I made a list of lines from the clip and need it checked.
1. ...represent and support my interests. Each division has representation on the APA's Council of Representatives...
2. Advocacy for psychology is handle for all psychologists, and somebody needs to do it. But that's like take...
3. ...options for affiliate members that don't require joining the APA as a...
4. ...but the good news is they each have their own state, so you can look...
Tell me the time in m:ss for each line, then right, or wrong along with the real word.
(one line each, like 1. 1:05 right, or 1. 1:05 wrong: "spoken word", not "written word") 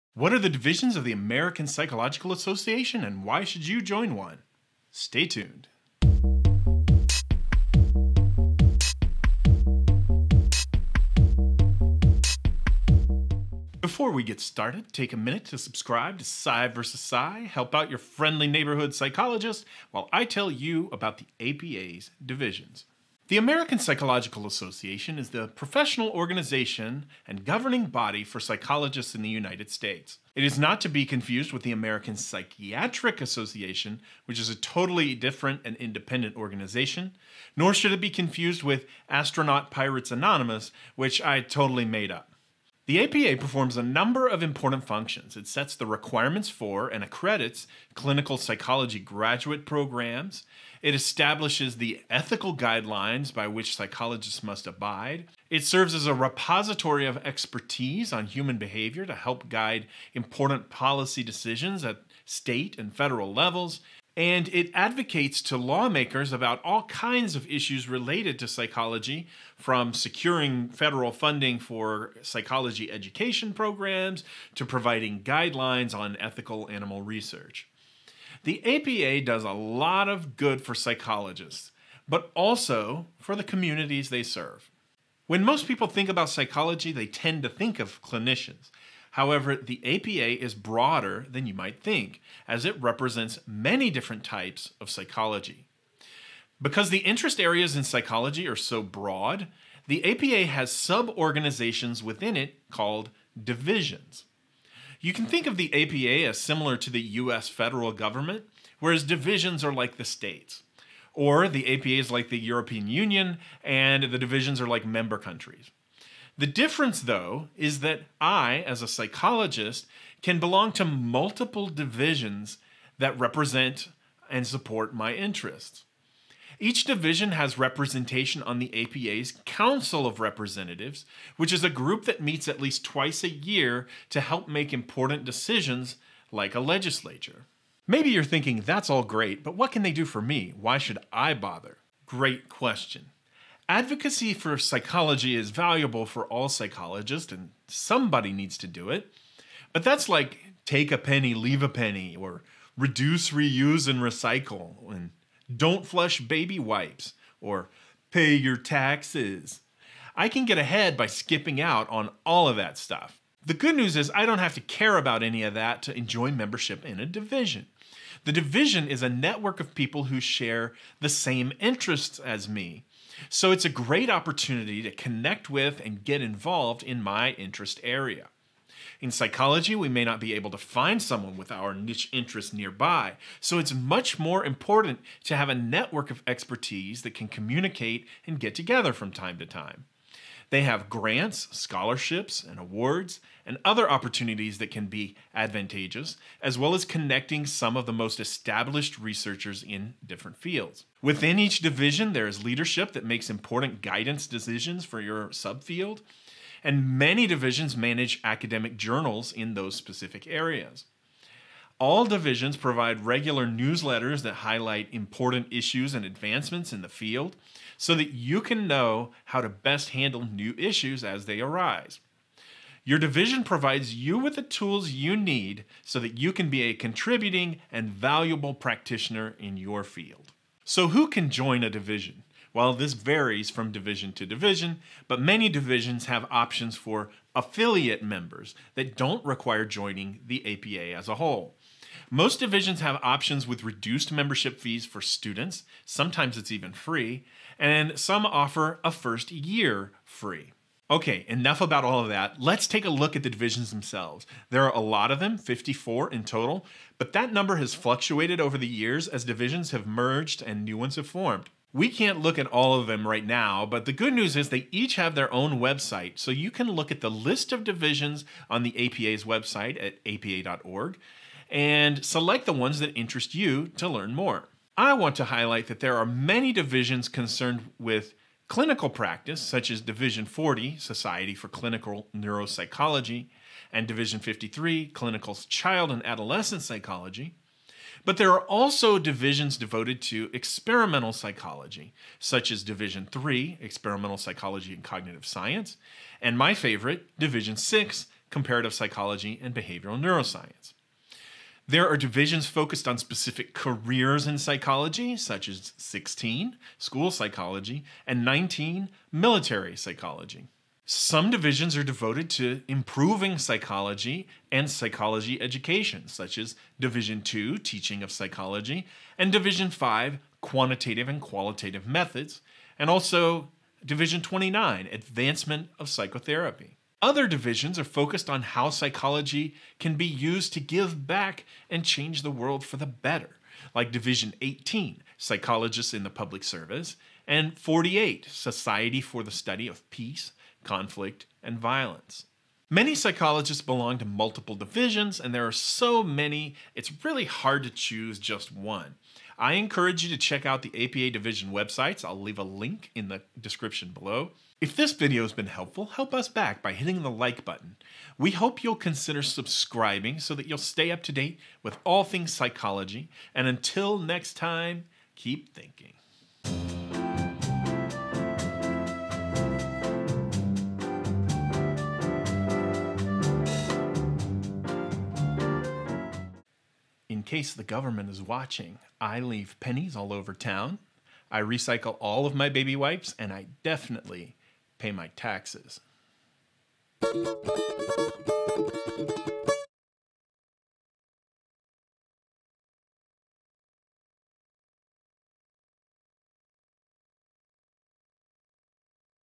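1. 2:03 right
2. 2:23 wrong: "valuable", not "handle"
3. 3:56 right
4. 4:23 wrong: "website", not "state".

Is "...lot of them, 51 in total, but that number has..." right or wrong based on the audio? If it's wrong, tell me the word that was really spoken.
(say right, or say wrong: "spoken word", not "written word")
wrong: "54", not "51".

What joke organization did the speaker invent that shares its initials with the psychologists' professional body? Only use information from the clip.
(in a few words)
Astronaut Pirates Anonymous.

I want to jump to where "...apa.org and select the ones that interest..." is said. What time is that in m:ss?
4:30.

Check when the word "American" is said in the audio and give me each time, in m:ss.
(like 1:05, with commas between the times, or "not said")
0:01, 0:23, 0:31.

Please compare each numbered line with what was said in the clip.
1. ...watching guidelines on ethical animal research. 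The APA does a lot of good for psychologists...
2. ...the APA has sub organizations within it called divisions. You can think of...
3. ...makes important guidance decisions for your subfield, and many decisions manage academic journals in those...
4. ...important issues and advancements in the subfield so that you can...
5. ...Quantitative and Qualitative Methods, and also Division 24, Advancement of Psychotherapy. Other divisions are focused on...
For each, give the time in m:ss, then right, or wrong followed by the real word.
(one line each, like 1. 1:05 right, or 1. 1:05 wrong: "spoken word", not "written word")
1. 1:14 wrong: "providing", not "watching"
2. 1:39 right
3. 3:23 wrong: "divisions", not "decisions"
4. 3:34 wrong: "field", not "subfield"
5. 5:20 wrong: "29", not "24".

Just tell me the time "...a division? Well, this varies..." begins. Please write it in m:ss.
3:51.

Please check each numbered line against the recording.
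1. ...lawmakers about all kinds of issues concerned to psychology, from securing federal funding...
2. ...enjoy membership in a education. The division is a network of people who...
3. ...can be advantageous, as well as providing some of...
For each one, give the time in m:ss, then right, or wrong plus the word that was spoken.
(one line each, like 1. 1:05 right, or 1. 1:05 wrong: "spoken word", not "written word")
1. 1:05 wrong: "related", not "concerned"
2. 2:45 wrong: "division", not "education"
3. 3:14 wrong: "connecting", not "providing".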